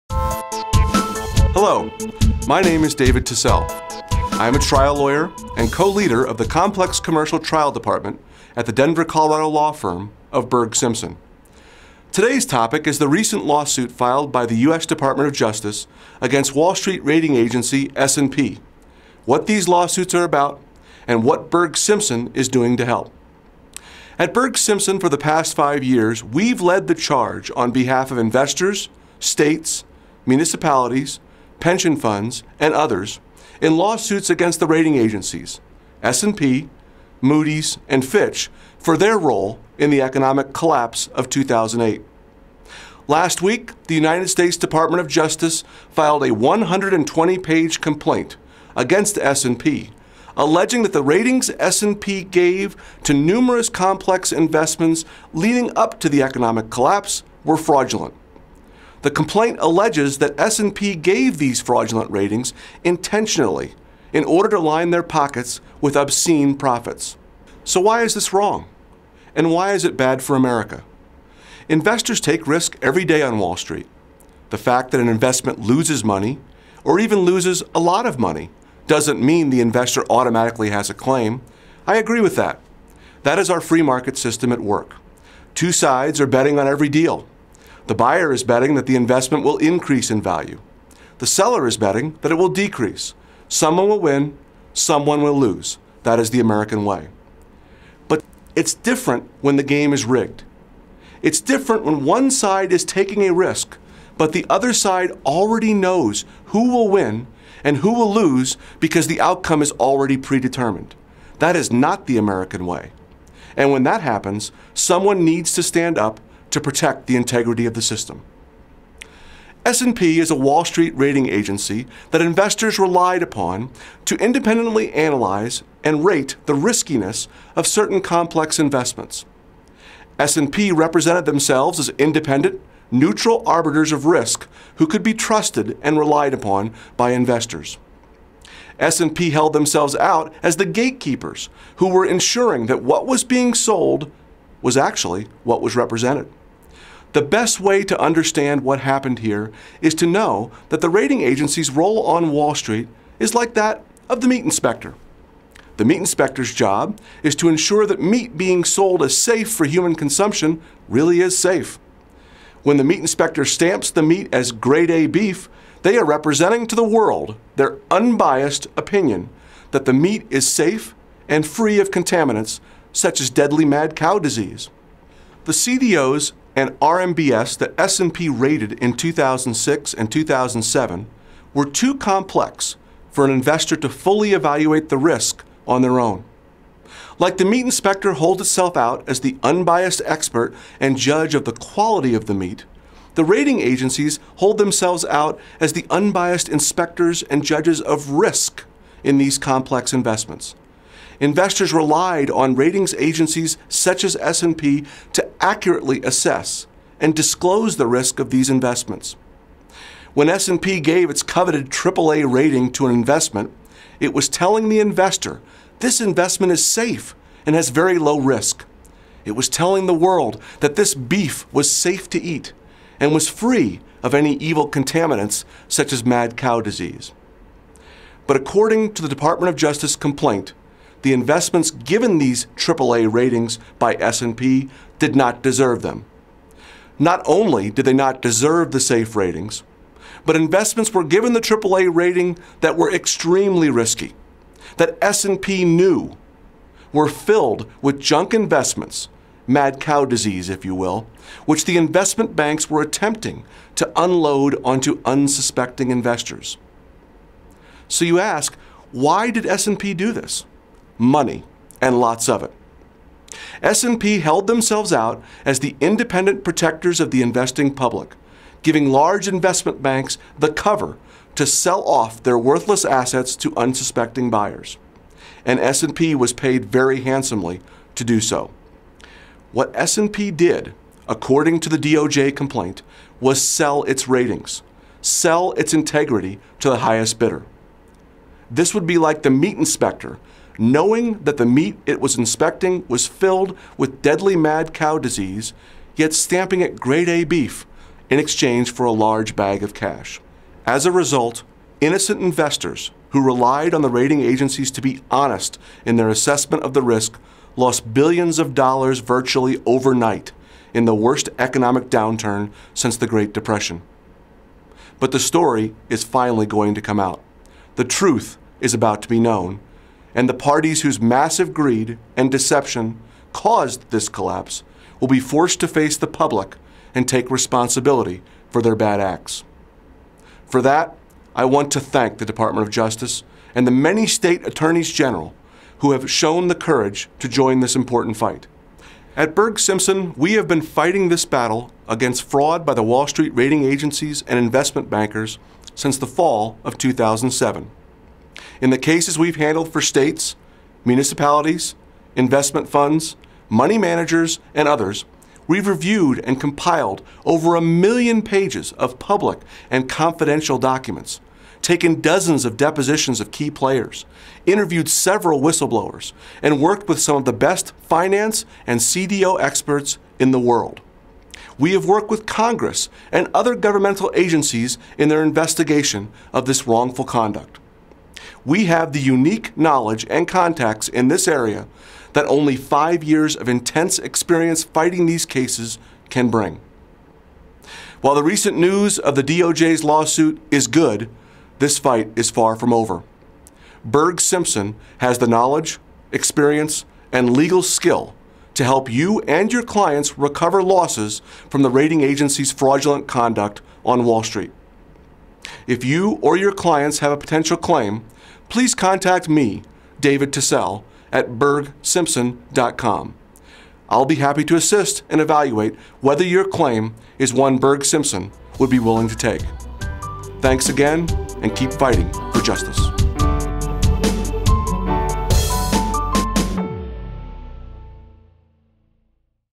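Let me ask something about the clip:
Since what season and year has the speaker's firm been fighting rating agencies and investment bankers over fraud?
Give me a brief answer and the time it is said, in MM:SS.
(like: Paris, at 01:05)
Fall of 2007, at 05:45.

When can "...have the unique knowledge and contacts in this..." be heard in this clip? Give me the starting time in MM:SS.
06:18.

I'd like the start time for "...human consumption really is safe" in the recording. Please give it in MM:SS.
02:39.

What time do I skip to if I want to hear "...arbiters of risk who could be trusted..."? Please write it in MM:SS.
02:13.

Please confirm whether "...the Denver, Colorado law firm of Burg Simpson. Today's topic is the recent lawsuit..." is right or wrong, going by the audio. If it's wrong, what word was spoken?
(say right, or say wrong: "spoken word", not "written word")
right.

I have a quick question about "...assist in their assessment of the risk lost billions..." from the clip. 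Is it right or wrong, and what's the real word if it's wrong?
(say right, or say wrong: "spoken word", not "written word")
wrong: "honest", not "assist".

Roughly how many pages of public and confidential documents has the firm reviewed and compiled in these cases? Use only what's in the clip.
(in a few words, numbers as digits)
Over a million.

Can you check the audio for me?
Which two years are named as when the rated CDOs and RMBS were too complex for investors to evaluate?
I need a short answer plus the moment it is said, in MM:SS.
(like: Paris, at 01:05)
2006 and 2007, at 02:58.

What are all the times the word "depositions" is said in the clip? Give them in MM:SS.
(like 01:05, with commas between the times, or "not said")
06:02.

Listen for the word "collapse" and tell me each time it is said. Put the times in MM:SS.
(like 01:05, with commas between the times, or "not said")
00:40, 00:56, 05:24.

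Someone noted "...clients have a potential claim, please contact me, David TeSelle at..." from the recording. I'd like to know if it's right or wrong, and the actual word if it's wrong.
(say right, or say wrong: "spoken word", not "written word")
right.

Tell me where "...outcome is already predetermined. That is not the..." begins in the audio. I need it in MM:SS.
01:49.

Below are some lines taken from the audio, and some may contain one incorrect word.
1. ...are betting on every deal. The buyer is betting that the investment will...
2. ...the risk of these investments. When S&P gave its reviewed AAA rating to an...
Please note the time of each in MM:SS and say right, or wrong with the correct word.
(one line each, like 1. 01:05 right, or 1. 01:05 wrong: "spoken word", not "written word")
1. 01:26 right
2. 03:27 wrong: "coveted", not "reviewed".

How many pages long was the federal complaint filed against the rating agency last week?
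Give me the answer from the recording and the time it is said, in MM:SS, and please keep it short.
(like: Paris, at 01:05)
120, at 00:46.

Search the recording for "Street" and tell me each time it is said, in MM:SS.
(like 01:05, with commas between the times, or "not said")
00:16, 01:13, 02:00, 02:32, 05:43, 06:44.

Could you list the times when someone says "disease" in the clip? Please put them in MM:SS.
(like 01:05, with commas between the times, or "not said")
02:54, 03:46, 04:10, 04:54.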